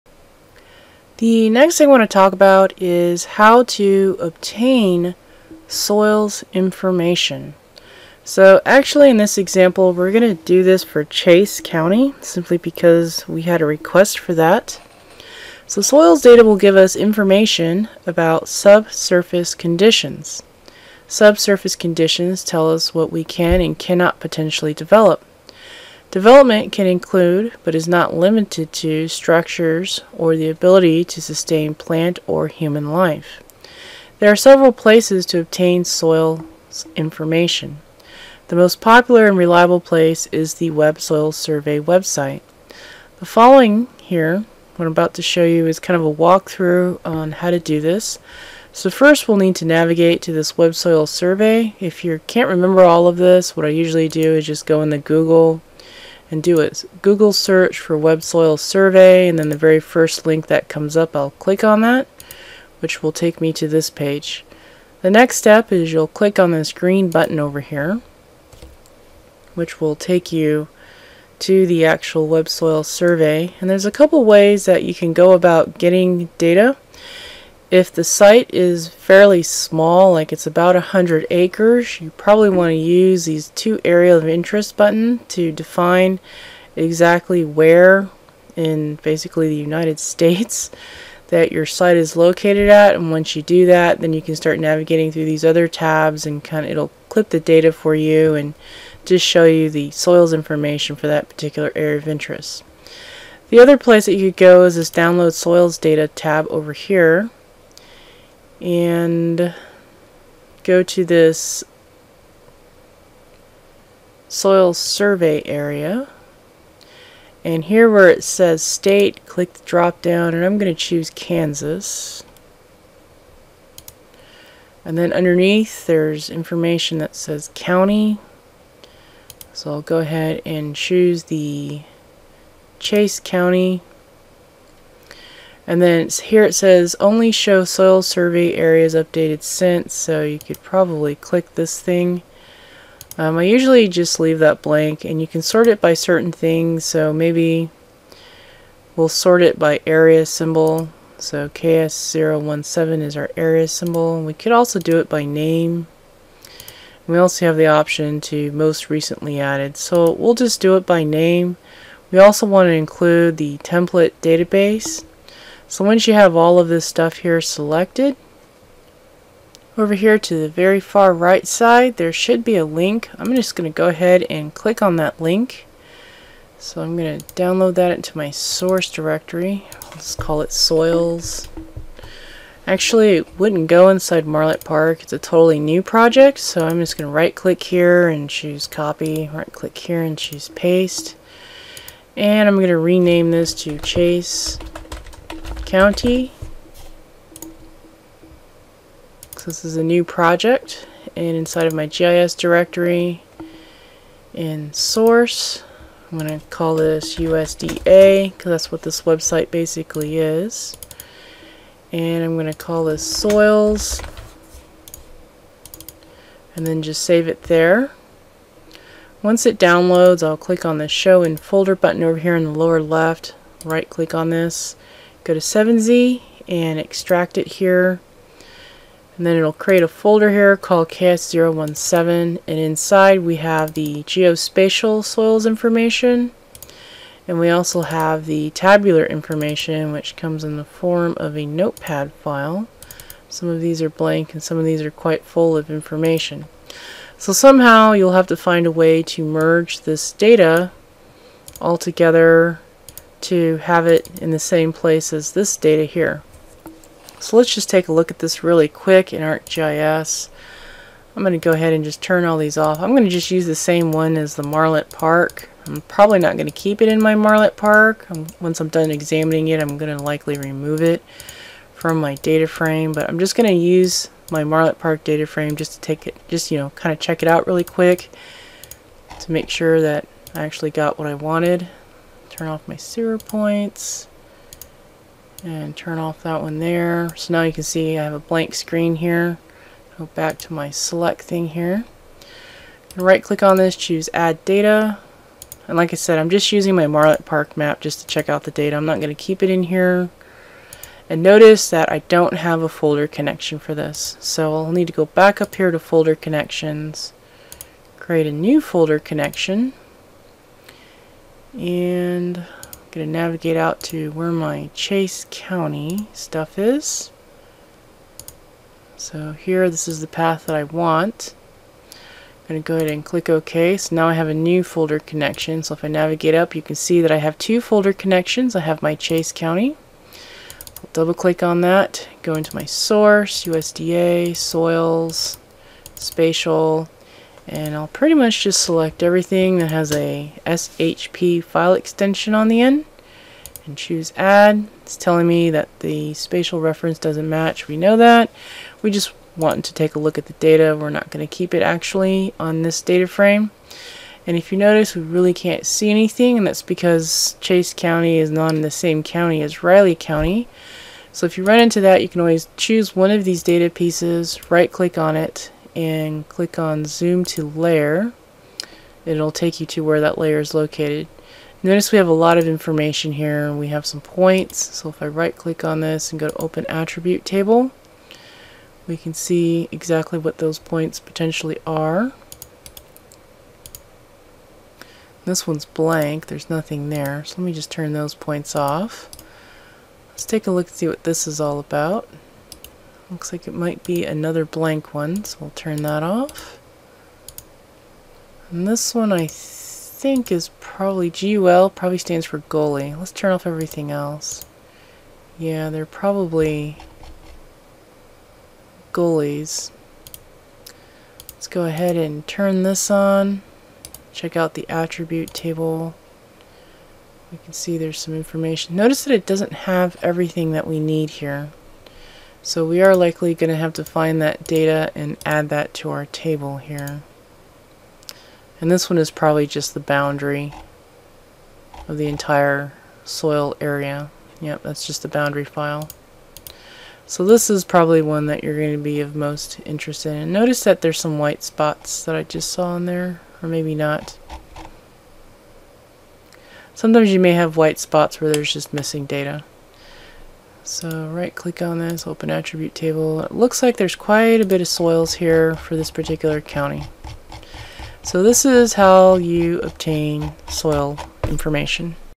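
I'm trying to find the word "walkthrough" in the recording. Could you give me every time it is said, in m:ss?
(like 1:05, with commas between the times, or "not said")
0:46.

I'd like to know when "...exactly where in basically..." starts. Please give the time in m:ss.
1:26.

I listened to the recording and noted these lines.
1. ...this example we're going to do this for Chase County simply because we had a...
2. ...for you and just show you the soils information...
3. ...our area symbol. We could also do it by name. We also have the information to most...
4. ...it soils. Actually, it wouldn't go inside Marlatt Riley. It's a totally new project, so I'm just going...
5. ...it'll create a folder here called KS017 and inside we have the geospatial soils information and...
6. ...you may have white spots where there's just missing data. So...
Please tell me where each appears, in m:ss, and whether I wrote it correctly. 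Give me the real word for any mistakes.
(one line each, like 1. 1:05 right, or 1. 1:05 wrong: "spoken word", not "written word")
1. 0:09 right
2. 1:37 right
3. 2:33 wrong: "option", not "information"
4. 3:00 wrong: "Park", not "Riley"
5. 3:49 right
6. 7:27 right.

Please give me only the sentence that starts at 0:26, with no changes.
Development can include, but is not limited to, structures or the ability to sustain plant or human life.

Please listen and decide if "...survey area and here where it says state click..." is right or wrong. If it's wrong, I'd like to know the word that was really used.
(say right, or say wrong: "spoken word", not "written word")
right.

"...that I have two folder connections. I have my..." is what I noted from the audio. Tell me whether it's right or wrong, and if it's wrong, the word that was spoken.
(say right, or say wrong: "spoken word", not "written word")
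right.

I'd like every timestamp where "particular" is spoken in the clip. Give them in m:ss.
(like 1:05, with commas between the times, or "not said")
1:41, 7:35.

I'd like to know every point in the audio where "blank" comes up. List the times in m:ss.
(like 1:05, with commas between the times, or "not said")
2:24, 4:03, 4:48, 6:25, 6:34.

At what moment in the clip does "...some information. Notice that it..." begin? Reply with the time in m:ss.
6:57.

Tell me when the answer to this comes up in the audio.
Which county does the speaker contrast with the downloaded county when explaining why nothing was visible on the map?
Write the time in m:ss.
5:59.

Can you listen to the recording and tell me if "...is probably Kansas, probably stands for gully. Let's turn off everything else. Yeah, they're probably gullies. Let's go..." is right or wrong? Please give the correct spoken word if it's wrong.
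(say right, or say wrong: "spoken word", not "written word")
wrong: "GUL", not "Kansas".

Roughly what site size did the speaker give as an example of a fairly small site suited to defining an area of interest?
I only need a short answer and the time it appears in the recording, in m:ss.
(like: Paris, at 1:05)
100 acres, at 1:20.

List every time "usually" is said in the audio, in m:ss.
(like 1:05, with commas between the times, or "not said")
0:53, 2:23.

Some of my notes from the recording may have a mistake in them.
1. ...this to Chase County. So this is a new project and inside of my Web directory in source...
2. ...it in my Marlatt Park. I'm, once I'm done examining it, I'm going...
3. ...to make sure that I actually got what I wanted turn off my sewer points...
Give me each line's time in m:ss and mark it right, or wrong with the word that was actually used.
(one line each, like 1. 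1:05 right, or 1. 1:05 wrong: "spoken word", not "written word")
1. 3:13 wrong: "GIS", not "Web"
2. 4:26 right
3. 4:39 right.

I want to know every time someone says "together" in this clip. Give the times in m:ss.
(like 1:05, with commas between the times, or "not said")
4:11.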